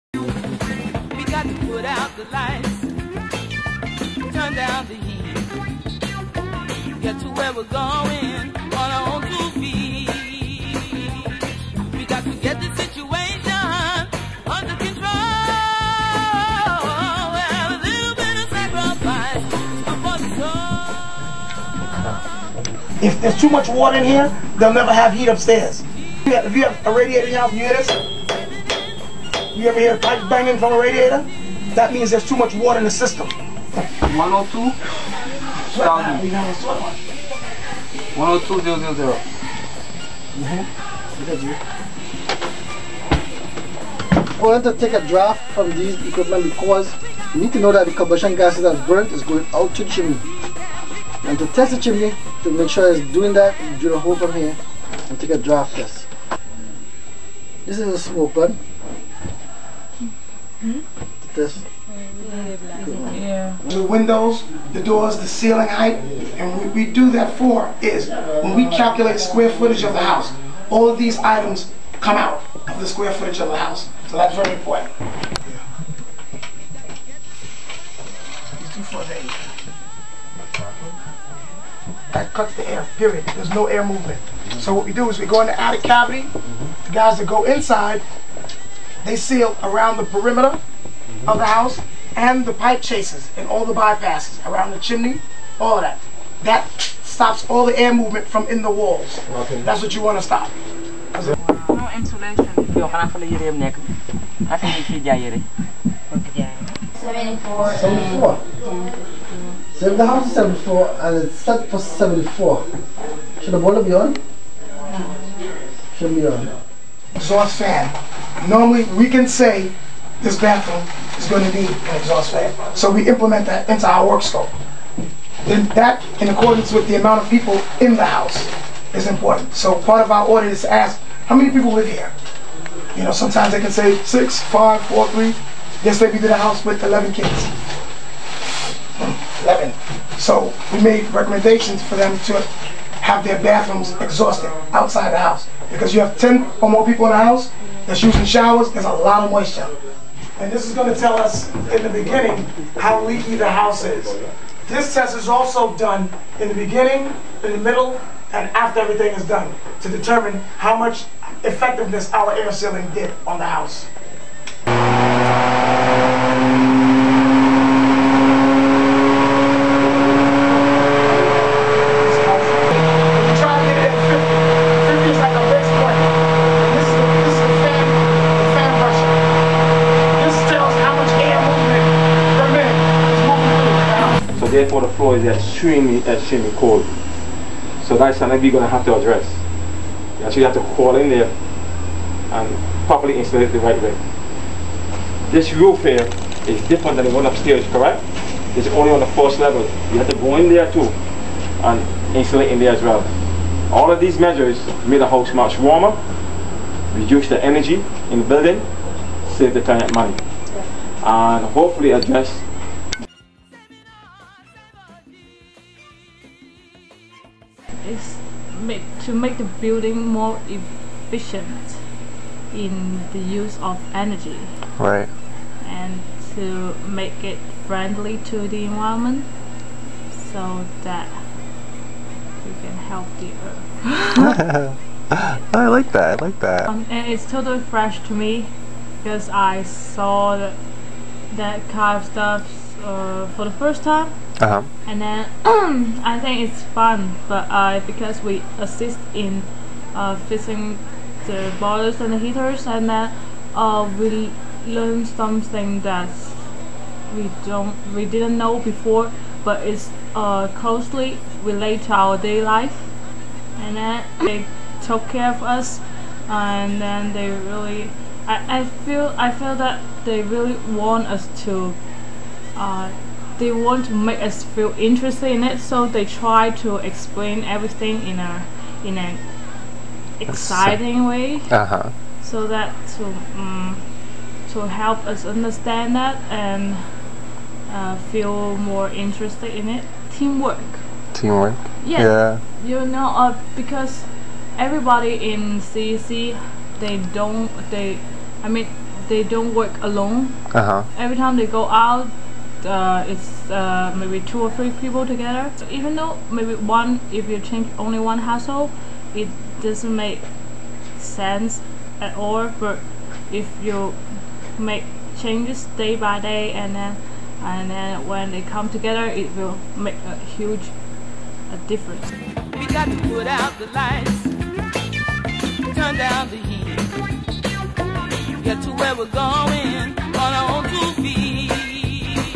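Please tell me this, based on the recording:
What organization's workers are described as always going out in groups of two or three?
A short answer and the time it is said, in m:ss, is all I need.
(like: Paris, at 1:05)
CEC, at 4:55.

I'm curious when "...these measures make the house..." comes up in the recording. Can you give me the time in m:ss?
3:23.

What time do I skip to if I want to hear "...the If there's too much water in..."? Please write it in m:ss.
0:22.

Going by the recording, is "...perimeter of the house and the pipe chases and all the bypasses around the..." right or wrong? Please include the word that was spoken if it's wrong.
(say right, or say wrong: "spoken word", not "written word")
right.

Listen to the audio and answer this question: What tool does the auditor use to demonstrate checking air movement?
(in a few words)
Smoke gun.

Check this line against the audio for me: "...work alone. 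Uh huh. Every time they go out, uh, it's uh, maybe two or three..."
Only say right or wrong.
right.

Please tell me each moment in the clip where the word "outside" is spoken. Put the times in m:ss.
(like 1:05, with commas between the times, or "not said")
2:24.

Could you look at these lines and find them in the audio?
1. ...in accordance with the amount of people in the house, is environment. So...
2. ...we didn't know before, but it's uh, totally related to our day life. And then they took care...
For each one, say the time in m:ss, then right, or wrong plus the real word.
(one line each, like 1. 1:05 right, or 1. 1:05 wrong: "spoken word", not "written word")
1. 2:06 wrong: "important", not "environment"
2. 4:17 wrong: "closely", not "totally".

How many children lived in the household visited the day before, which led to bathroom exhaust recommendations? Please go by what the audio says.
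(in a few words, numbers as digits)
11.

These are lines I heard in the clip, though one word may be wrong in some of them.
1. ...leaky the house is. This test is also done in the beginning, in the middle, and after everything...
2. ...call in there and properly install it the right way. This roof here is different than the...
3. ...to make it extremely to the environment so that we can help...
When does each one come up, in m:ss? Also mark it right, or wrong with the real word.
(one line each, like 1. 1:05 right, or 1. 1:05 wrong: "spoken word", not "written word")
1. 2:33 right
2. 3:10 right
3. 3:46 wrong: "friendly", not "extremely".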